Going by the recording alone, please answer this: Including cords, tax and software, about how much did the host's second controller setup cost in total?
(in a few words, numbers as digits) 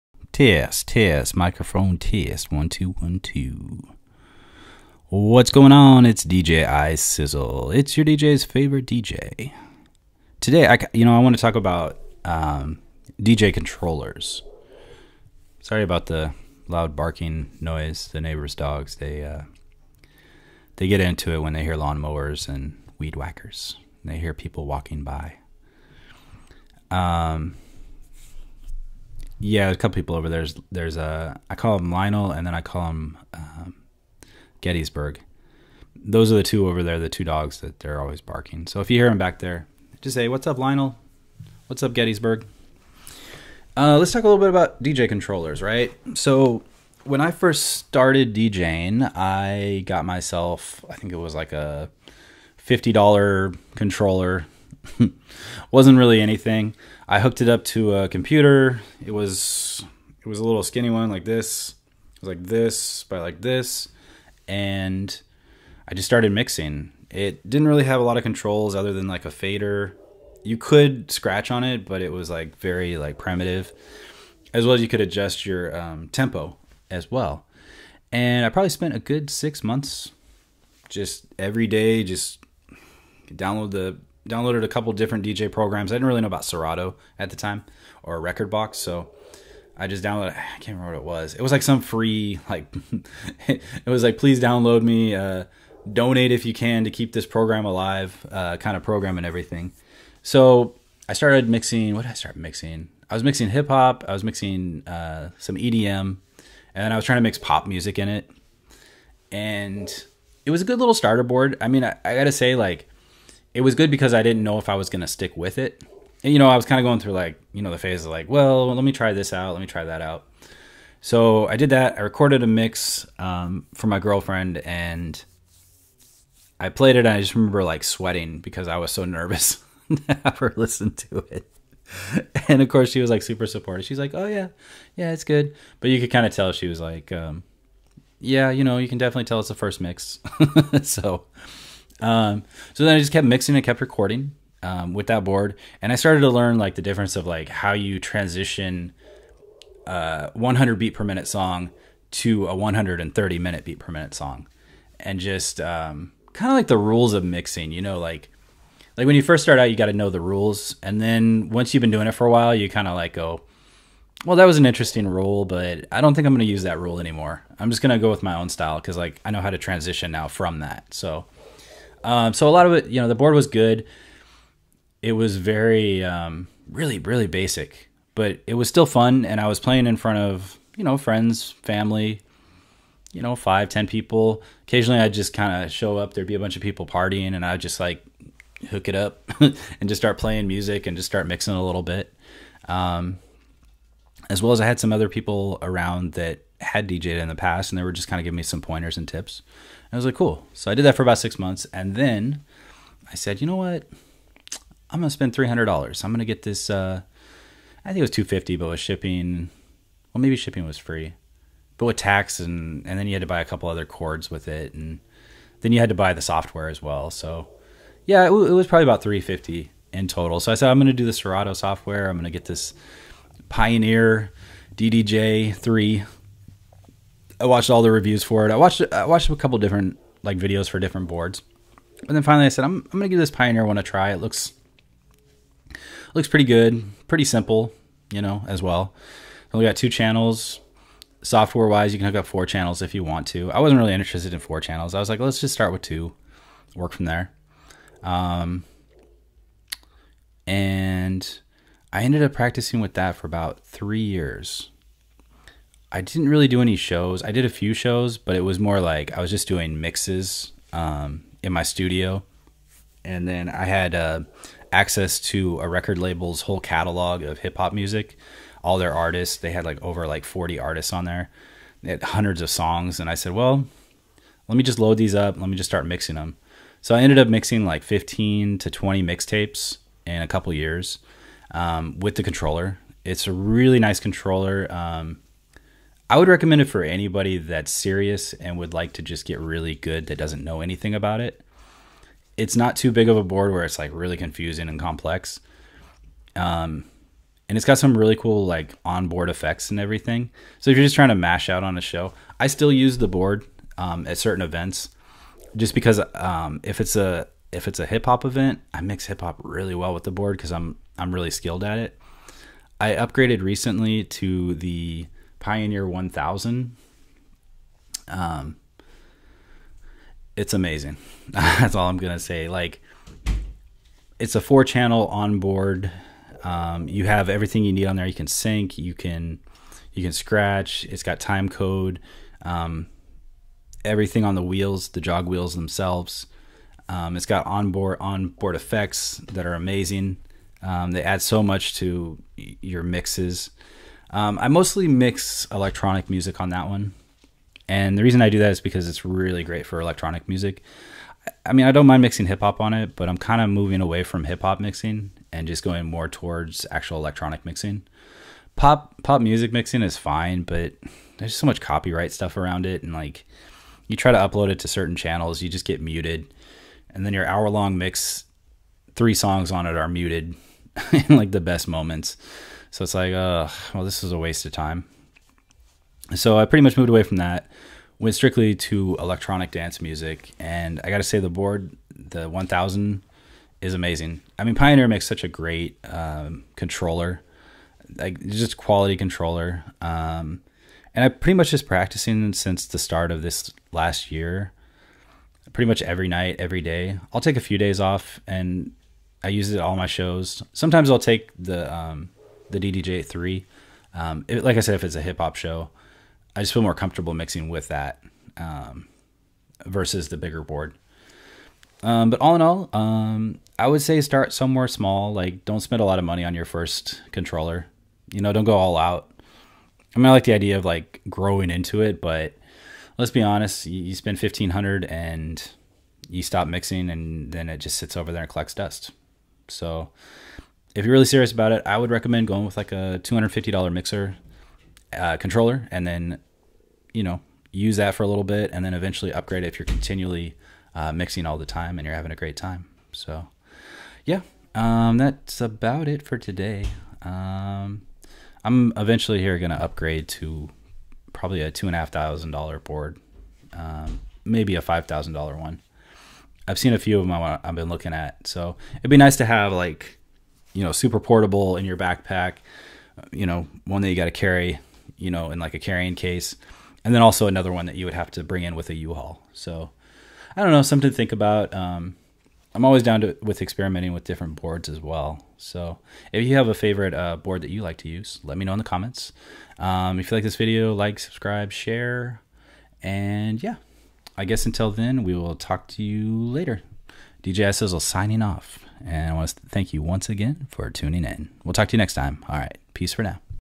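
350.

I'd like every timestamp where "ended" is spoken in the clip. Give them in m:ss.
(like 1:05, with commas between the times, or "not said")
4:12, 4:37.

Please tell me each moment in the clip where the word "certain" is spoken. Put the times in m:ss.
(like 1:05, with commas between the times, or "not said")
5:04, 6:04.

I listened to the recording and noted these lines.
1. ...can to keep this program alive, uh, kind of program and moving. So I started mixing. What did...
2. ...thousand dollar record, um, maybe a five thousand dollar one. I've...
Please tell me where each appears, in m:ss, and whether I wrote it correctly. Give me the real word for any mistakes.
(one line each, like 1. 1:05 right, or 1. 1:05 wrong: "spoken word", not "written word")
1. 1:36 wrong: "everything", not "moving"
2. 7:31 wrong: "board", not "record".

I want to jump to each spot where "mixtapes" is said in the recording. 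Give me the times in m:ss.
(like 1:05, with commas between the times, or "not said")
4:39.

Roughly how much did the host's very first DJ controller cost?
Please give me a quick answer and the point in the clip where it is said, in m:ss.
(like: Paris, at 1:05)
$50, at 0:52.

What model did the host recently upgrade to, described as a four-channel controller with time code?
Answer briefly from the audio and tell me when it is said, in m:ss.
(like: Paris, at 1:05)
Pioneer 1000, at 5:15.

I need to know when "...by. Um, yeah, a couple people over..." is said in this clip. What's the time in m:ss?
0:25.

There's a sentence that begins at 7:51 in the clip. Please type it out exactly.
Um, I'm always down to with experimenting with different boards as well.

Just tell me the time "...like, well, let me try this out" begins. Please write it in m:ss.
1:58.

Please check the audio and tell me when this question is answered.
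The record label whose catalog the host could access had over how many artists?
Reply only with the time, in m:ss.
4:30.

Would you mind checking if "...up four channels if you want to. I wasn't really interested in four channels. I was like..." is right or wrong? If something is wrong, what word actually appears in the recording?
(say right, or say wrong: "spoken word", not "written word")
right.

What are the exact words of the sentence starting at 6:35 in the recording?
Pretty much every night, every day.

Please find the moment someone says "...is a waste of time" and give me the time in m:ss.
6:14.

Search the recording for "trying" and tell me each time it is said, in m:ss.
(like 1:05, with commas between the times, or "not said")
1:47, 5:00.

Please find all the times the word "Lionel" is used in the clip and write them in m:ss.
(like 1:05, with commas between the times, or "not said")
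0:31, 0:40.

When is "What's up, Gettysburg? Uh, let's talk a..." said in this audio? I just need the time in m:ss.
0:41.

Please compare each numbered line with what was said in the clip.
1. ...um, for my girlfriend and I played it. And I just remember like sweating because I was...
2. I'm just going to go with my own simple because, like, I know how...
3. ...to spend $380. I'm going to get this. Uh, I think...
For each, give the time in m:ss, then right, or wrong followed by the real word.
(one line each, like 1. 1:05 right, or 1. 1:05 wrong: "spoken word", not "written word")
1. 2:03 right
2. 2:47 wrong: "style", not "simple"
3. 3:25 wrong: "300", not "380".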